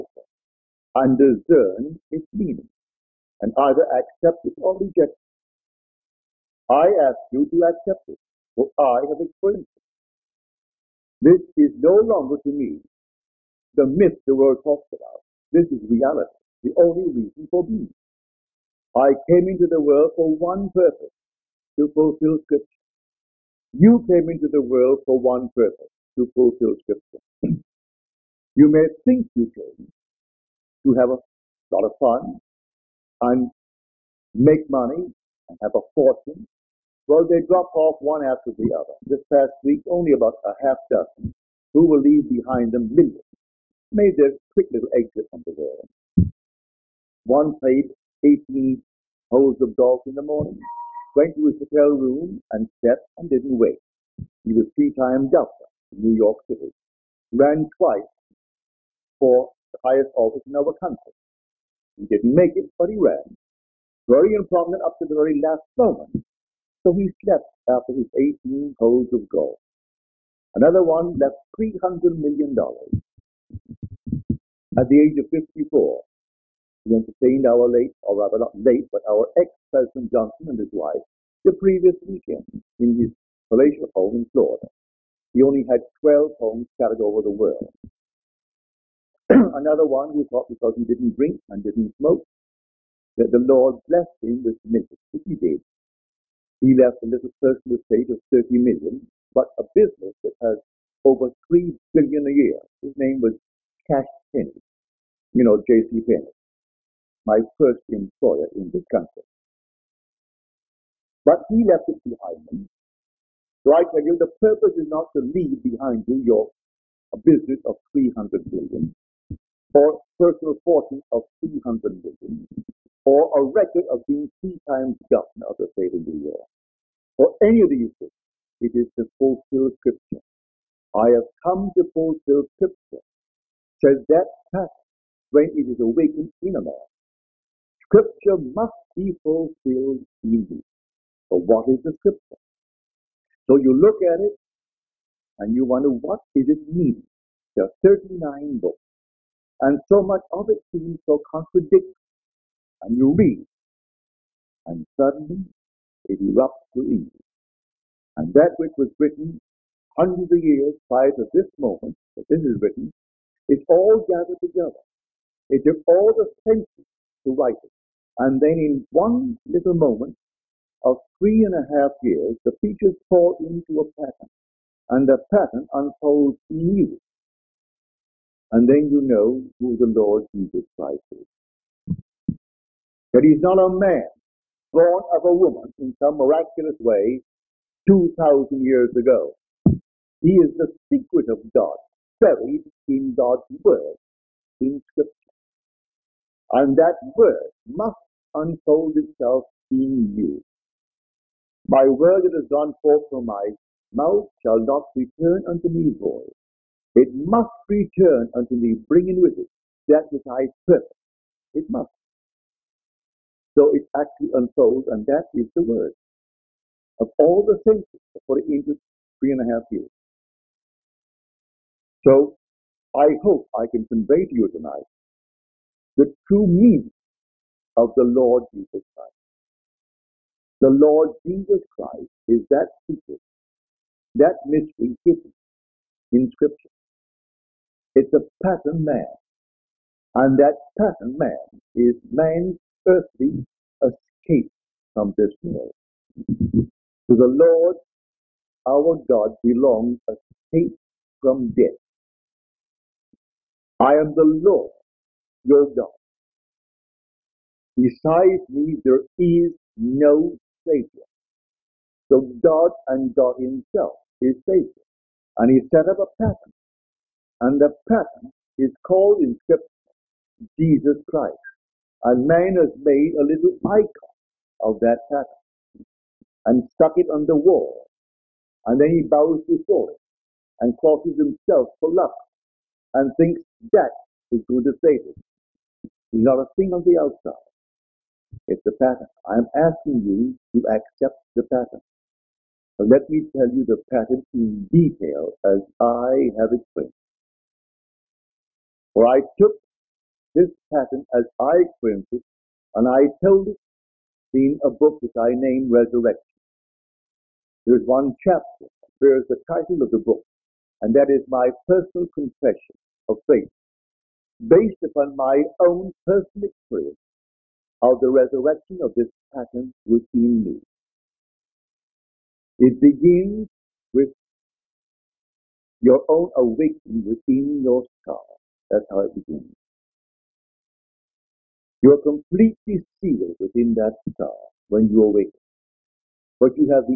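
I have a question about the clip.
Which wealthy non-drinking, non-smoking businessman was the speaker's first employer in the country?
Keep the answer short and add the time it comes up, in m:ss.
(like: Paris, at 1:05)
J.C. Penny, at 1:45.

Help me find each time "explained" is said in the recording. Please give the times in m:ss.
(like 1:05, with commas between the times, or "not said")
4:56.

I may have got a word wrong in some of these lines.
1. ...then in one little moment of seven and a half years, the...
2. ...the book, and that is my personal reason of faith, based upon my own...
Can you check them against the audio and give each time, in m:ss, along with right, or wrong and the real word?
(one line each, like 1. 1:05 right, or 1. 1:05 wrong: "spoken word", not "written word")
1. 2:48 wrong: "three", not "seven"
2. 5:09 wrong: "confession", not "reason".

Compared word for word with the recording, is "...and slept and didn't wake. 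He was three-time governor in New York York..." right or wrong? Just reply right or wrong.
wrong.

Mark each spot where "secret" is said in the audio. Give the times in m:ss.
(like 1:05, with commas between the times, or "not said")
3:10, 3:52.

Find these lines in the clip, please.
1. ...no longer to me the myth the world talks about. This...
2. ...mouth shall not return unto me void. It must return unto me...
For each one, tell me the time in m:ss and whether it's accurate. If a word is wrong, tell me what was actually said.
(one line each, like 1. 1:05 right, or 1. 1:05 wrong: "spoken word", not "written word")
1. 0:11 right
2. 3:23 right.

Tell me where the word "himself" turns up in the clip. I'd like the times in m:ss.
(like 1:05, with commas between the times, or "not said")
4:23, 4:41.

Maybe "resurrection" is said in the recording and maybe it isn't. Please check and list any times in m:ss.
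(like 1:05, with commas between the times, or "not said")
5:05, 5:18.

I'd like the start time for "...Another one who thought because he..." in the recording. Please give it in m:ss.
1:29.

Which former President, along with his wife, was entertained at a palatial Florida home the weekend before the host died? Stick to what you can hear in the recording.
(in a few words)
Johnson.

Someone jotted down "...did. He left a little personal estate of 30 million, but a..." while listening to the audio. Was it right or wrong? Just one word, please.
right.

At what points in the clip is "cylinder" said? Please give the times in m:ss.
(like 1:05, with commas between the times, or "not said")
not said.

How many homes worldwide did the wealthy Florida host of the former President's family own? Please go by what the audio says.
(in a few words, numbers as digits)
12.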